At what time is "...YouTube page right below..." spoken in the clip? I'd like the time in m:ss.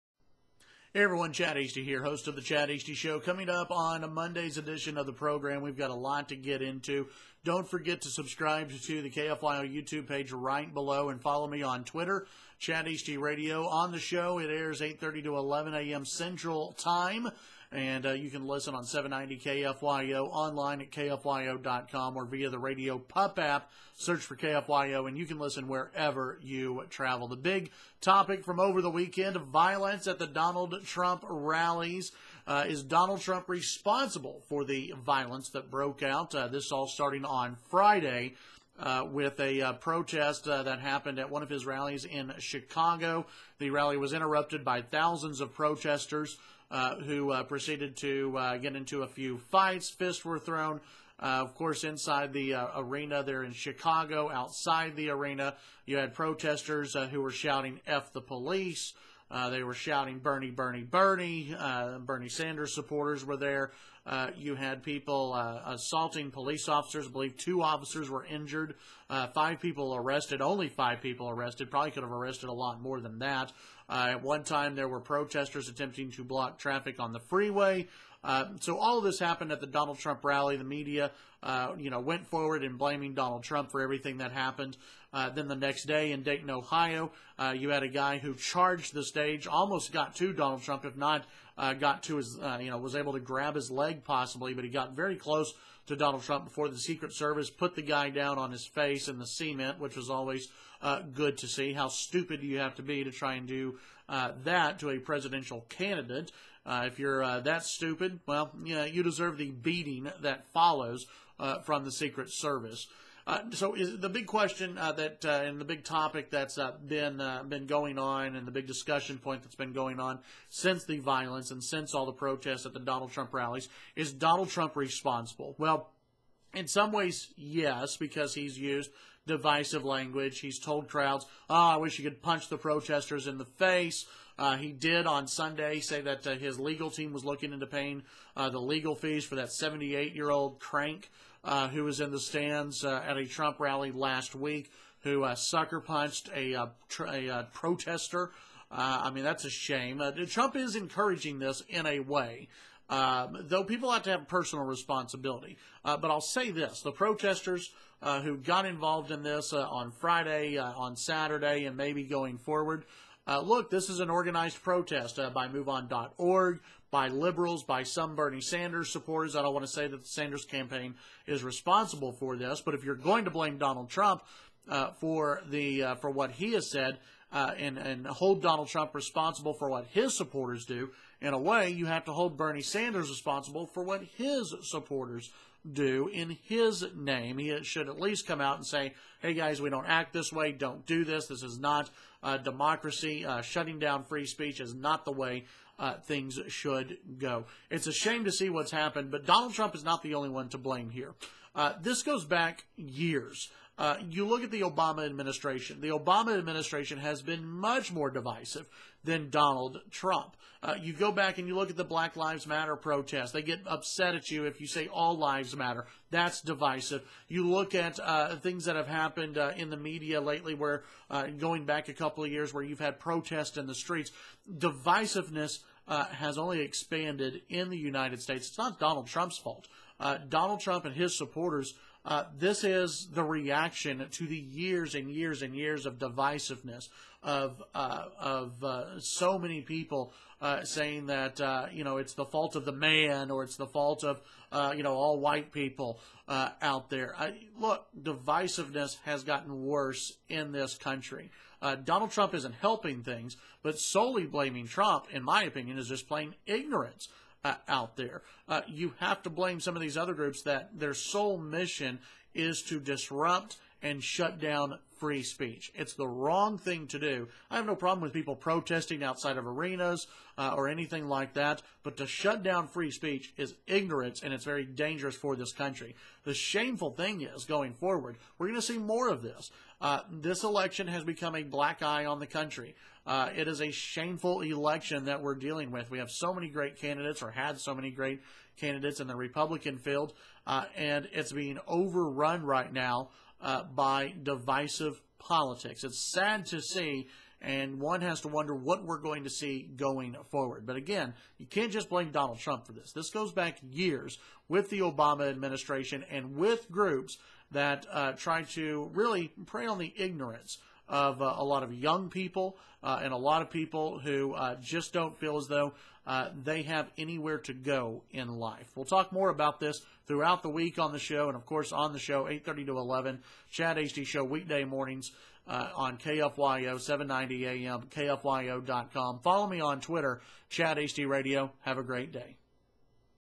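0:09.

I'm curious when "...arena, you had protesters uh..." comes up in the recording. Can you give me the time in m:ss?
0:55.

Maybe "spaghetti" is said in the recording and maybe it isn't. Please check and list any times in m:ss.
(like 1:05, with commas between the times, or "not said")
not said.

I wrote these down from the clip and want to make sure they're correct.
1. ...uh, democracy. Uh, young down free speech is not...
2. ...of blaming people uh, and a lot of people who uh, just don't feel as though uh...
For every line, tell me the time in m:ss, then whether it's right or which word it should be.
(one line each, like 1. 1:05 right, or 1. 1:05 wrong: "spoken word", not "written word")
1. 3:12 wrong: "shutting", not "young"
2. 5:11 wrong: "young", not "blaming".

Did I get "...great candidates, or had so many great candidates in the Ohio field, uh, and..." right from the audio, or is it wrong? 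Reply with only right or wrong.
wrong.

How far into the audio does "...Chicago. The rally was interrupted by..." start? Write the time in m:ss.
0:42.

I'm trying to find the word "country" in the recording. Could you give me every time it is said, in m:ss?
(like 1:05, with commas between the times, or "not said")
4:10, 4:35, 4:42.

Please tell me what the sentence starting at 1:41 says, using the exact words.
How stupid do you have to be to try and do uh, that to a presidential candidate.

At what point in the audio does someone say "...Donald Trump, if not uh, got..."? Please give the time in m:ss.
1:30.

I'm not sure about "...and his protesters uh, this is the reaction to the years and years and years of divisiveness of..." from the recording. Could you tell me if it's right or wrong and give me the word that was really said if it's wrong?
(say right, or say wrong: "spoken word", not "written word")
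wrong: "supporters", not "protesters".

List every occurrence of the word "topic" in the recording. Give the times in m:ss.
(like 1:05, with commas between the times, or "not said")
0:28, 1:55.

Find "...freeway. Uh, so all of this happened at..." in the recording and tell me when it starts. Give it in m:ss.
1:17.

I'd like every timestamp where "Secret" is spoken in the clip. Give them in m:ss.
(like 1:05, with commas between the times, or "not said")
1:36, 1:51.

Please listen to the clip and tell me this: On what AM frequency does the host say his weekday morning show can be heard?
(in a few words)
790 AM.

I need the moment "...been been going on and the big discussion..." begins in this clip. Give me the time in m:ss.
1:56.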